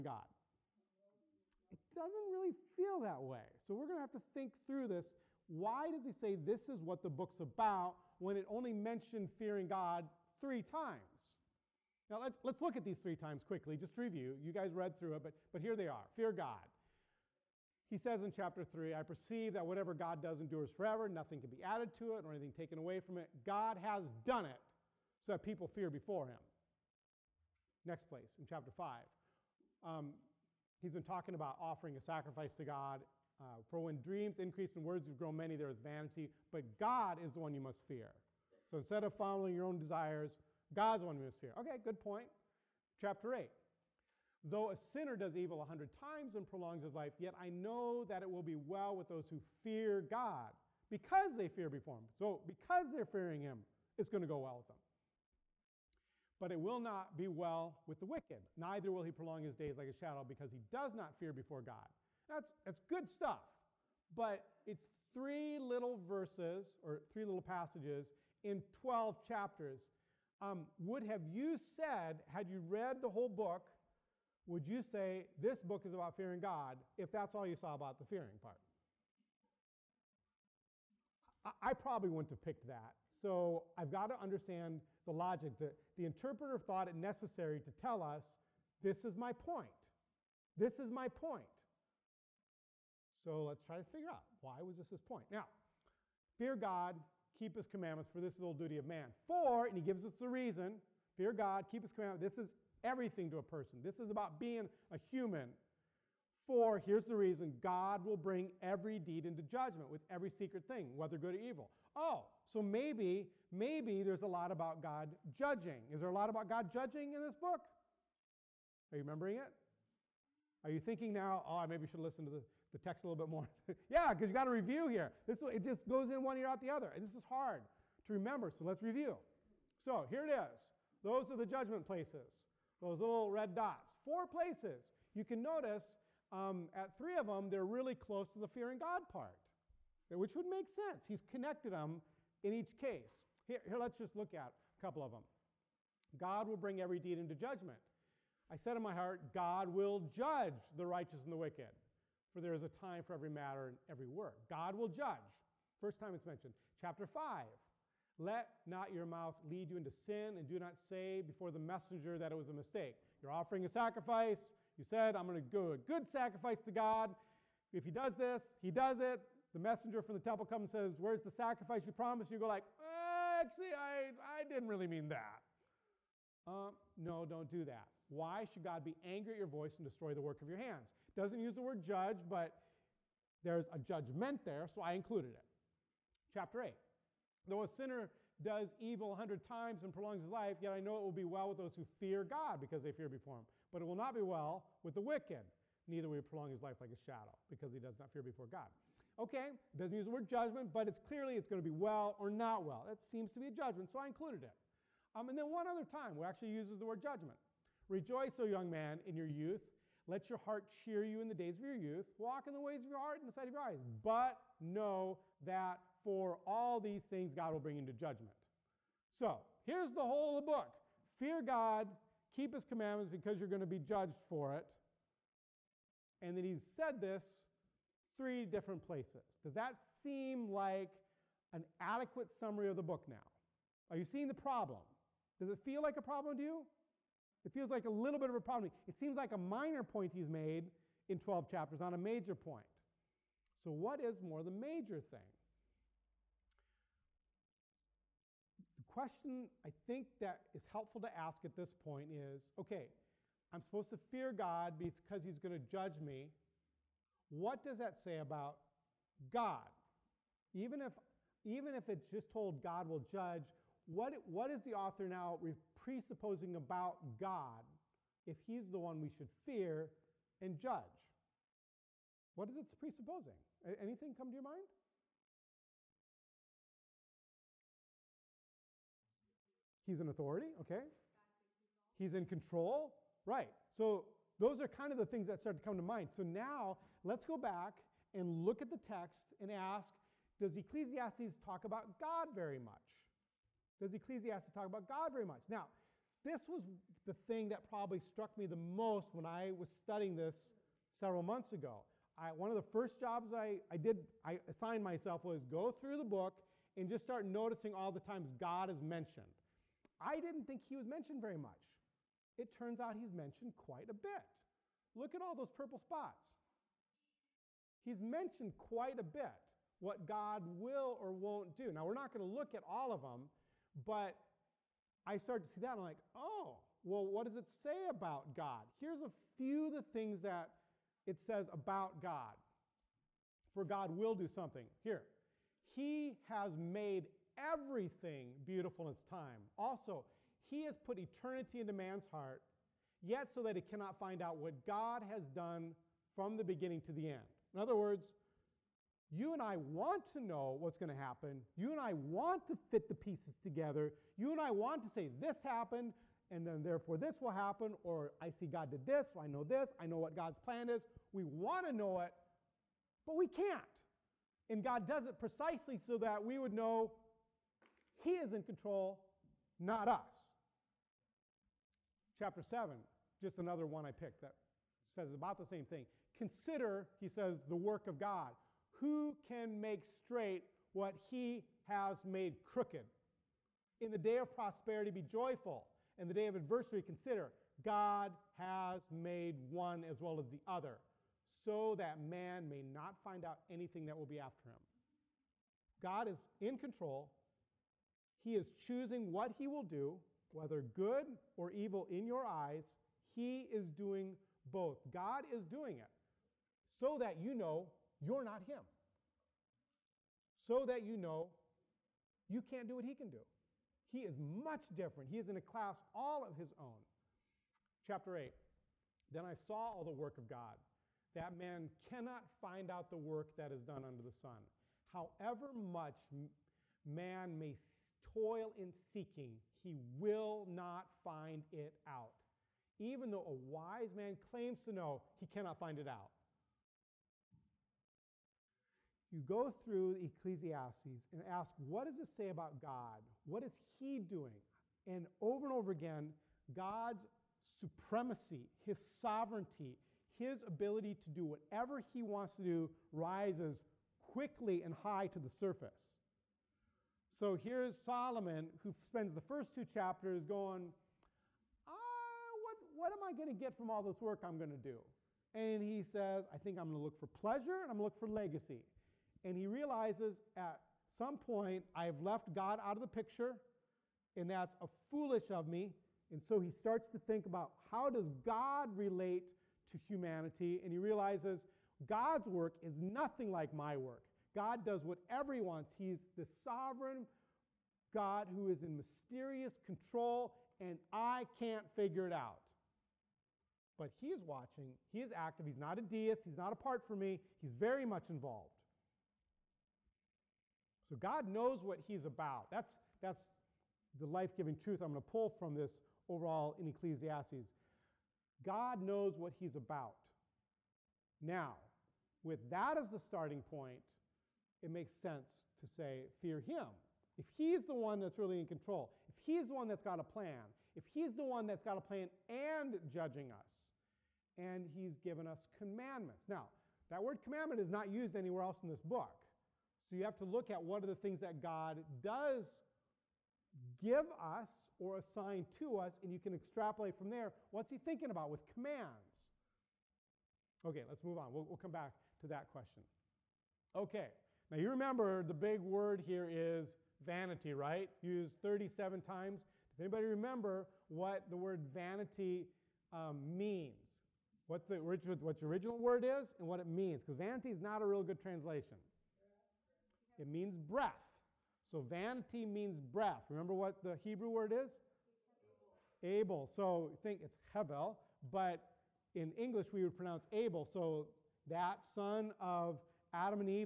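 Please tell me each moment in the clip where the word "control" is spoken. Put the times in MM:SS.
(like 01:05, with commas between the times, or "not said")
04:42, 06:08, 06:36, 08:09, 08:38.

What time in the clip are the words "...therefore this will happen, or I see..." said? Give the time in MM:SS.
05:56.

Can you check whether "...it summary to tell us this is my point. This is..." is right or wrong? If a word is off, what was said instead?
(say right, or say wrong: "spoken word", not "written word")
wrong: "necessary", not "summary".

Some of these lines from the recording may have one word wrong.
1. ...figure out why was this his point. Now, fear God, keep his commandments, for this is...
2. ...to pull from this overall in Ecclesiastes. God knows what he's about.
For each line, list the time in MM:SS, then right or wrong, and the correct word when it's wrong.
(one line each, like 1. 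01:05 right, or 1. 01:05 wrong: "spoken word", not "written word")
1. 01:33 right
2. 08:25 right.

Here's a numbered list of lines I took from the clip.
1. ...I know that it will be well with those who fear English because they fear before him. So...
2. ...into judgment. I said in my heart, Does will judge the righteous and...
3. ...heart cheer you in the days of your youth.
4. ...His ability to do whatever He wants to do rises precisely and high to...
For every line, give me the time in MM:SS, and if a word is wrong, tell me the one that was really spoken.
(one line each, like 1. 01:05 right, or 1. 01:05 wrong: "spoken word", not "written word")
1. 00:47 wrong: "God", not "English"
2. 02:27 wrong: "God", not "Does"
3. 03:30 right
4. 07:30 wrong: "quickly", not "precisely".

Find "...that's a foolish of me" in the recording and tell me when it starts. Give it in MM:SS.
07:54.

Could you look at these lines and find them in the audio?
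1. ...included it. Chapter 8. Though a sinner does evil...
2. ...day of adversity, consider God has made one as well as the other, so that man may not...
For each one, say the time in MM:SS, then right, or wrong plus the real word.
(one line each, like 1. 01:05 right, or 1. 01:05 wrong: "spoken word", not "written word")
1. 03:04 right
2. 06:26 right.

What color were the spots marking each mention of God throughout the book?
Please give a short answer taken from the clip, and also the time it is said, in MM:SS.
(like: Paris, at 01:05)
Purple, at 05:15.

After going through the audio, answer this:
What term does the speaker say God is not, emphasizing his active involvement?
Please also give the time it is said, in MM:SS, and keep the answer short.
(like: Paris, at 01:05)
A deist, at 08:15.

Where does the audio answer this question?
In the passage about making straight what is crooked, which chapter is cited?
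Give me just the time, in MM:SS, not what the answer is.
06:12.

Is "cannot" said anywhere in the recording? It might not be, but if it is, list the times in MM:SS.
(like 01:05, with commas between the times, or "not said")
05:43, 07:01, 07:15.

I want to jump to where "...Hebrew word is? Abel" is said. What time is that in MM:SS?
09:23.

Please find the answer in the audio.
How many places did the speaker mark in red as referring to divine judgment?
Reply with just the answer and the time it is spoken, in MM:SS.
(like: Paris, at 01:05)
4, at 02:14.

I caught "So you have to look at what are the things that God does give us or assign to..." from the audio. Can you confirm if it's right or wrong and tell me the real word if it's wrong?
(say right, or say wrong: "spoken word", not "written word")
right.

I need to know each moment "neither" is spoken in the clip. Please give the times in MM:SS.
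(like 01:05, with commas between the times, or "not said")
00:58, 03:15.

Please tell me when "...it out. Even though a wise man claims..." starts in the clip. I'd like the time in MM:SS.
07:11.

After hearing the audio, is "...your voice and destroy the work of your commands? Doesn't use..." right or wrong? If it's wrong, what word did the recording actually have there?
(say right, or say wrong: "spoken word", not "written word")
wrong: "hands", not "commands".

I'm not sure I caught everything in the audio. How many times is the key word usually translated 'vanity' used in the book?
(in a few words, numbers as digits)
37.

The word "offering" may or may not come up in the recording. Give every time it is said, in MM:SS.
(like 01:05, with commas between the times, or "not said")
00:31, 02:43.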